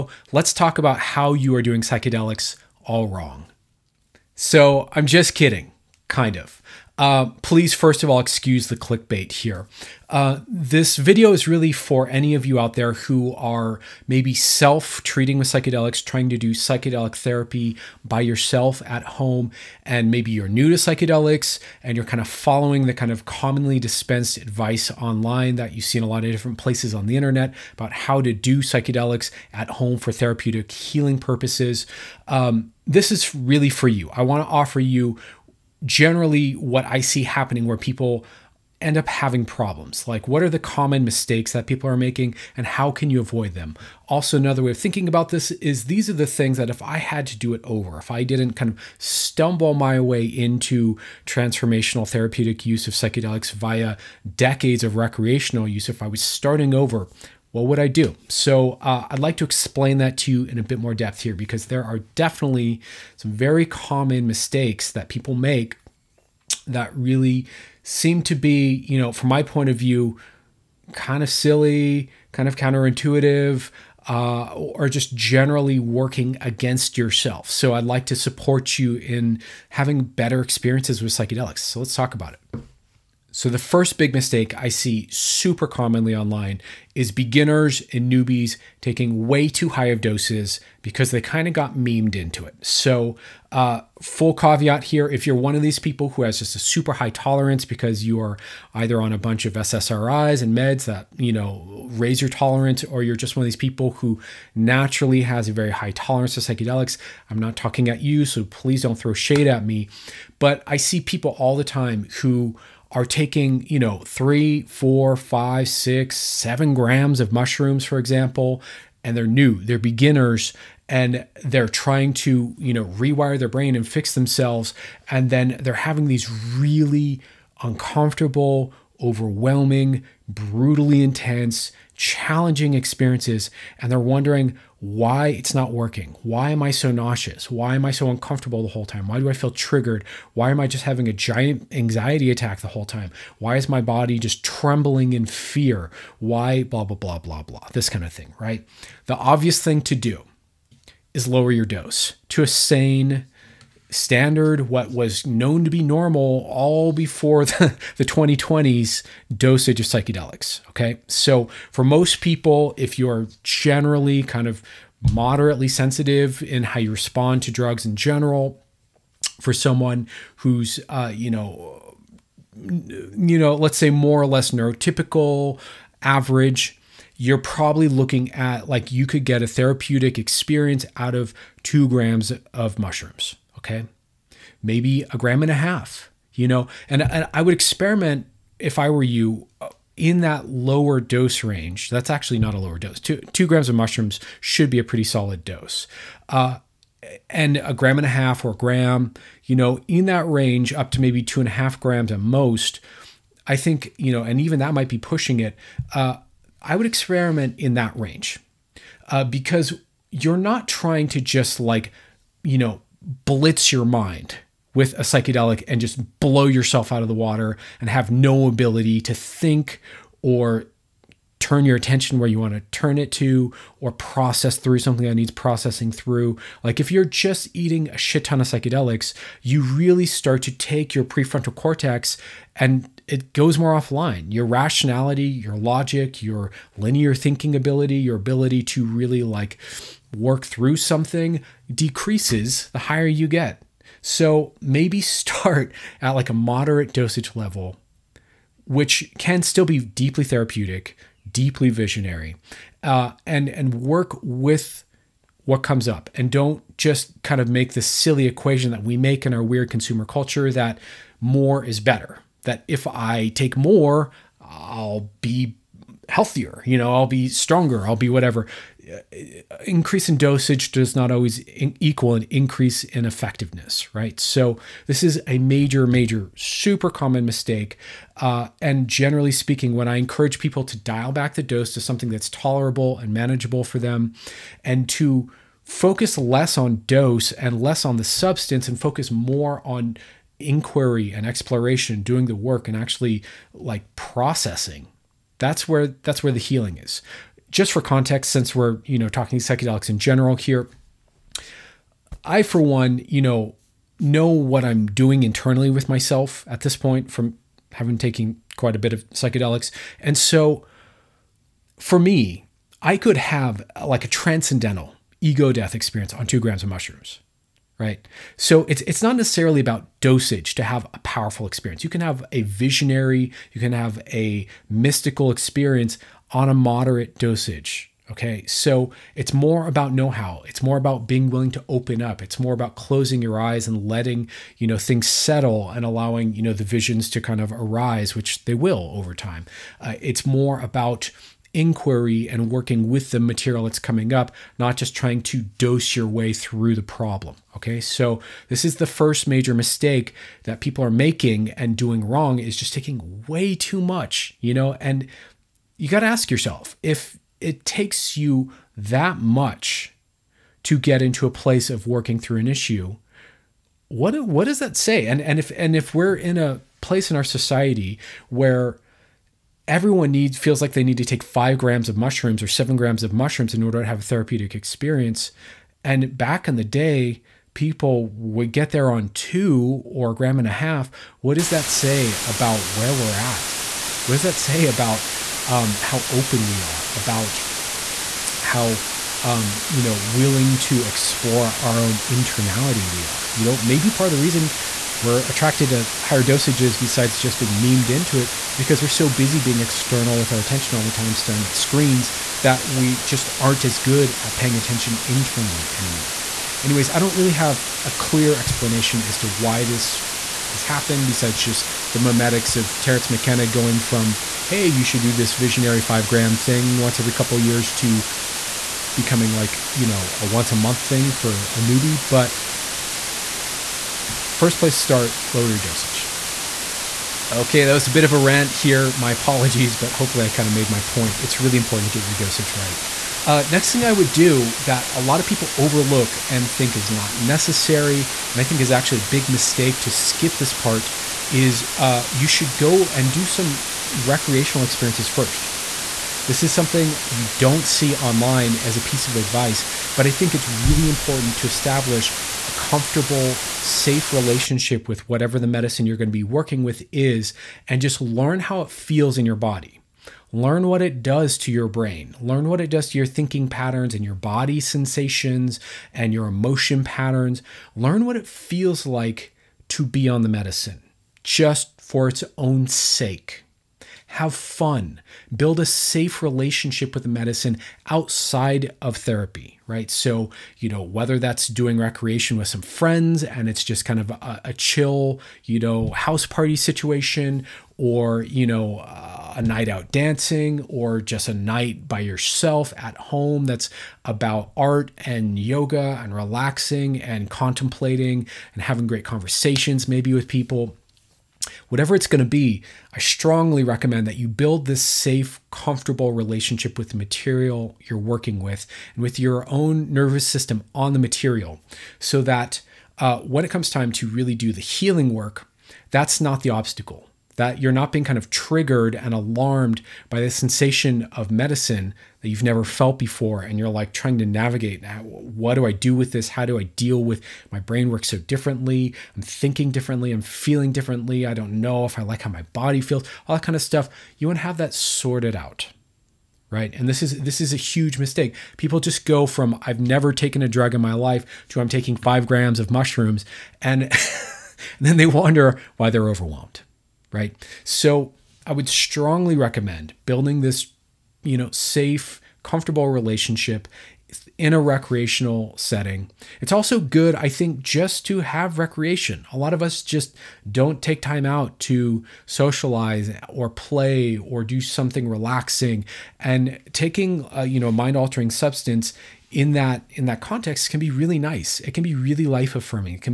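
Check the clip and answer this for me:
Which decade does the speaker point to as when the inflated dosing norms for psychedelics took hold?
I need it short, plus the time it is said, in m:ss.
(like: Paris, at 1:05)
2020s, at 2:37.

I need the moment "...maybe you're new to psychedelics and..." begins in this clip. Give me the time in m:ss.
0:20.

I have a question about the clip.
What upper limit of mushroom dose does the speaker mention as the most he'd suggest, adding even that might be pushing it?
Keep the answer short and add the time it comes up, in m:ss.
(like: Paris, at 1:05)
2.5 grams, at 3:21.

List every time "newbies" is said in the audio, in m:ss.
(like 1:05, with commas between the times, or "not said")
1:28, 7:01.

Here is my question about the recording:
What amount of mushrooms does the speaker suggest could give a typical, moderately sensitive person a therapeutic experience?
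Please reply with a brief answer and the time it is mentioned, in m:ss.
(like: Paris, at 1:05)
2 grams, at 3:01.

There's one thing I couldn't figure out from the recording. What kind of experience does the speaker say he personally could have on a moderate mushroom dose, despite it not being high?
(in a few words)
transcendental ego death.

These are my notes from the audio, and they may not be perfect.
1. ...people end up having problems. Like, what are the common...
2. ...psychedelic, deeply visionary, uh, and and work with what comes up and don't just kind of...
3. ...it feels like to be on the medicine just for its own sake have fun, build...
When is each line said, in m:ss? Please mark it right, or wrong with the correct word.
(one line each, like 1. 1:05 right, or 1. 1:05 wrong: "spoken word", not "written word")
1. 0:37 right
2. 4:10 wrong: "therapeutic", not "psychedelic"
3. 7:48 right.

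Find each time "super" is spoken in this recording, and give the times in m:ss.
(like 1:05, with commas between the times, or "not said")
1:25, 1:36, 4:36.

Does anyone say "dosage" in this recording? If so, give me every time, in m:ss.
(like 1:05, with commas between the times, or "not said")
2:39, 4:06, 4:30, 5:19, 5:27, 6:36, 7:05, 7:12.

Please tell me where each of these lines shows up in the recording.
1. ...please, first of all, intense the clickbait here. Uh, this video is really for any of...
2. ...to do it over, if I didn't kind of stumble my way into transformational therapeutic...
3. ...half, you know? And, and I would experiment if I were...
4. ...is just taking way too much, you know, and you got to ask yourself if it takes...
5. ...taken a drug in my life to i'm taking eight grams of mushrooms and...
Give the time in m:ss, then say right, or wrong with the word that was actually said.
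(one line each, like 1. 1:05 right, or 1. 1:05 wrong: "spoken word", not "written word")
1. 0:07 wrong: "excuse", not "intense"
2. 0:47 right
3. 3:05 right
4. 5:52 right
5. 9:00 wrong: "five", not "eight".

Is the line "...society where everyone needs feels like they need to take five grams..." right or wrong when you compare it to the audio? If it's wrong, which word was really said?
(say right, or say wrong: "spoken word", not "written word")
right.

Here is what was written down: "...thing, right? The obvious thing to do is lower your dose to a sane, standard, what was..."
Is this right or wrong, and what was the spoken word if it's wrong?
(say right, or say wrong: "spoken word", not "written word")
right.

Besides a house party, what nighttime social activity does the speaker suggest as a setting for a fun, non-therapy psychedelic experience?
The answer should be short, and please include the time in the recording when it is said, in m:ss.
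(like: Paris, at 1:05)
dancing, at 8:09.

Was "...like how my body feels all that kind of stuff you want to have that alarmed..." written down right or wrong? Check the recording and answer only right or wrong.
wrong.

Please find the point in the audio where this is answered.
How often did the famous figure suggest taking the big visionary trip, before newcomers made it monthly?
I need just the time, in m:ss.
6:56.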